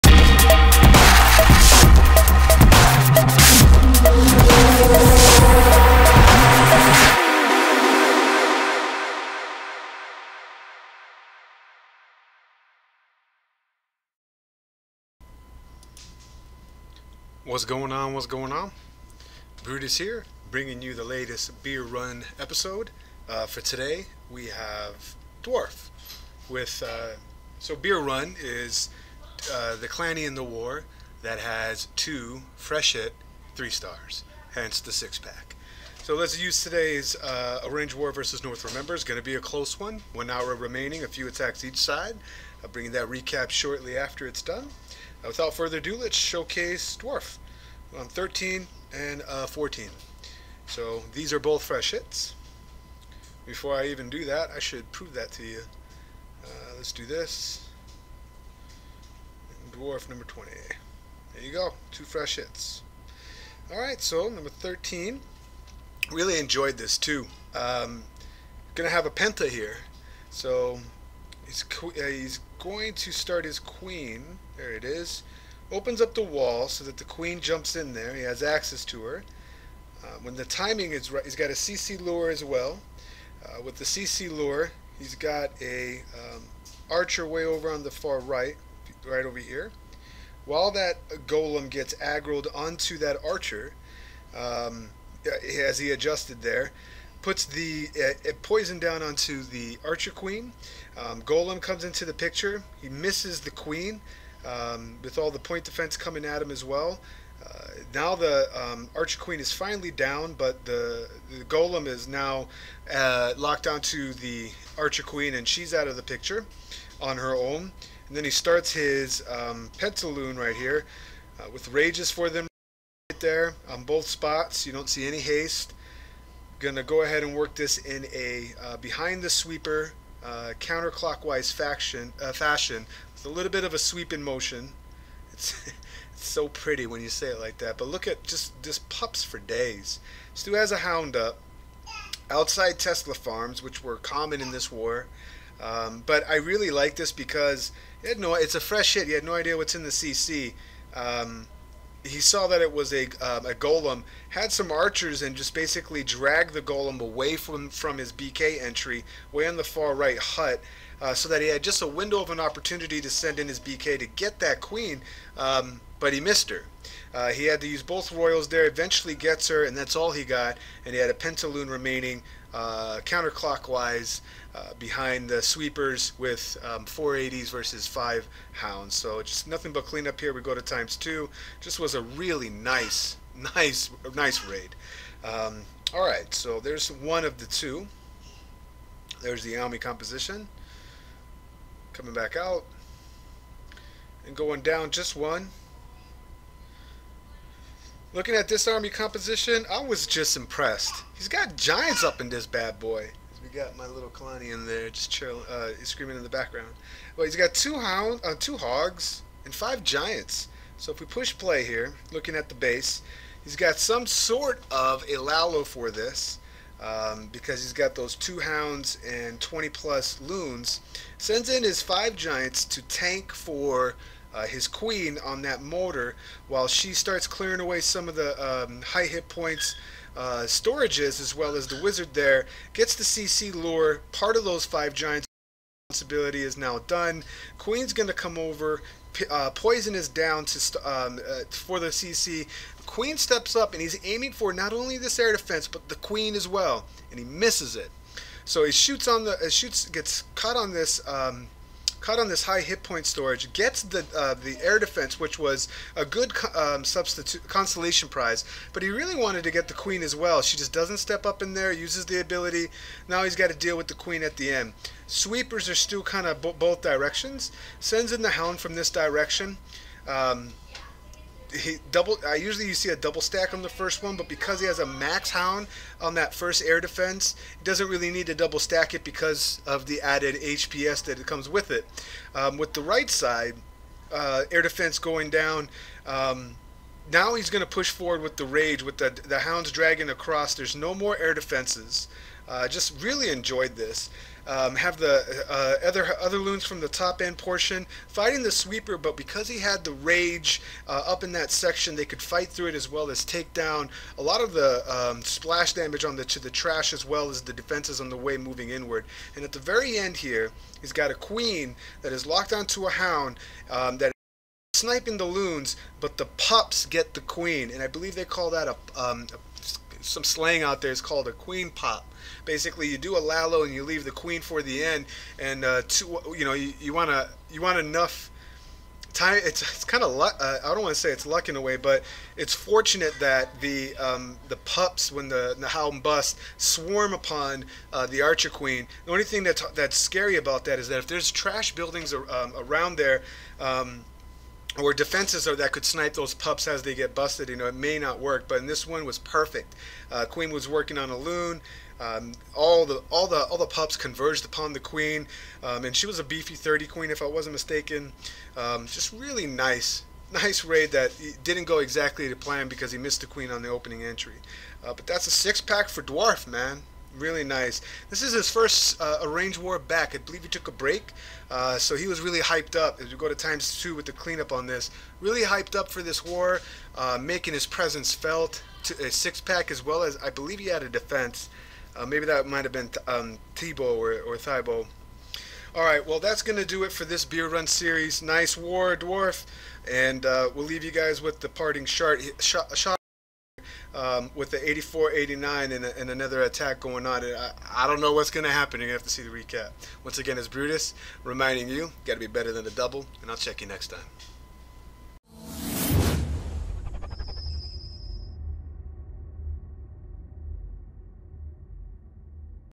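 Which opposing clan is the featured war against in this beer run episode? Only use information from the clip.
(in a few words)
North Remember.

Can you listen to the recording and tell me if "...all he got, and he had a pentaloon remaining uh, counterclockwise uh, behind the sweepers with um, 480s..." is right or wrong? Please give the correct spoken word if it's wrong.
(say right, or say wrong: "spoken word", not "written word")
right.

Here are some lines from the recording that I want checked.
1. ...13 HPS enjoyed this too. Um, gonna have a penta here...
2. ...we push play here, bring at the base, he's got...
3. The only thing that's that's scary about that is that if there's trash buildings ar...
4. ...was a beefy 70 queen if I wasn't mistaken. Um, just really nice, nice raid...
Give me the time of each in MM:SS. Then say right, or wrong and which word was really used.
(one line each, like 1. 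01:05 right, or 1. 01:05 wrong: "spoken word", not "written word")
1. 01:04 wrong: "Really", not "HPS"
2. 03:30 wrong: "looking", not "bring"
3. 05:39 right
4. 05:56 wrong: "30", not "70".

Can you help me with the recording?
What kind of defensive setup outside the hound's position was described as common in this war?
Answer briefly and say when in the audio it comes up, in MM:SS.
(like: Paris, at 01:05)
Tesla farms, at 02:22.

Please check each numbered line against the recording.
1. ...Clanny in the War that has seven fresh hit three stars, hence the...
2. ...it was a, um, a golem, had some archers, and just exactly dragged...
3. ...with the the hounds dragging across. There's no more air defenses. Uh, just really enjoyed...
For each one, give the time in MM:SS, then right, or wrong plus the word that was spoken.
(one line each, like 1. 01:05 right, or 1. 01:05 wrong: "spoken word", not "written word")
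1. 00:29 wrong: "two", not "seven"
2. 02:32 wrong: "basically", not "exactly"
3. 04:48 right.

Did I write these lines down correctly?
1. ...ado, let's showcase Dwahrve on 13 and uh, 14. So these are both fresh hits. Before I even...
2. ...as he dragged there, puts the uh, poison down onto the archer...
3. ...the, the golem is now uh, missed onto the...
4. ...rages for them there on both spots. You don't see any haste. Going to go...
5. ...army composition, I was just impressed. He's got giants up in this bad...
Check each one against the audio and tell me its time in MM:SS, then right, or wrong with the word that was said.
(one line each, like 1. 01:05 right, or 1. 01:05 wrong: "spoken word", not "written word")
1. 00:45 right
2. 01:35 wrong: "adjusted", not "dragged"
3. 01:50 wrong: "locked", not "missed"
4. 02:01 right
5. 03:18 right.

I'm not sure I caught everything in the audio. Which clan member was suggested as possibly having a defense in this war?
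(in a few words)
Tebow.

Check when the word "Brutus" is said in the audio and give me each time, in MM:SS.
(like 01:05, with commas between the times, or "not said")
00:19, 06:40.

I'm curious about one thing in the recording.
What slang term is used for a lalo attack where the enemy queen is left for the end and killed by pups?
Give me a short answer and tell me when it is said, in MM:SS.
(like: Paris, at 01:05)
queen pop, at 05:21.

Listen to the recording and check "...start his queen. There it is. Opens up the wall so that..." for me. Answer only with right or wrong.
right.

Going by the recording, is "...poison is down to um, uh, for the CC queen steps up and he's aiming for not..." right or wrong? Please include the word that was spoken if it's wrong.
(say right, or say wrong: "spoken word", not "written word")
right.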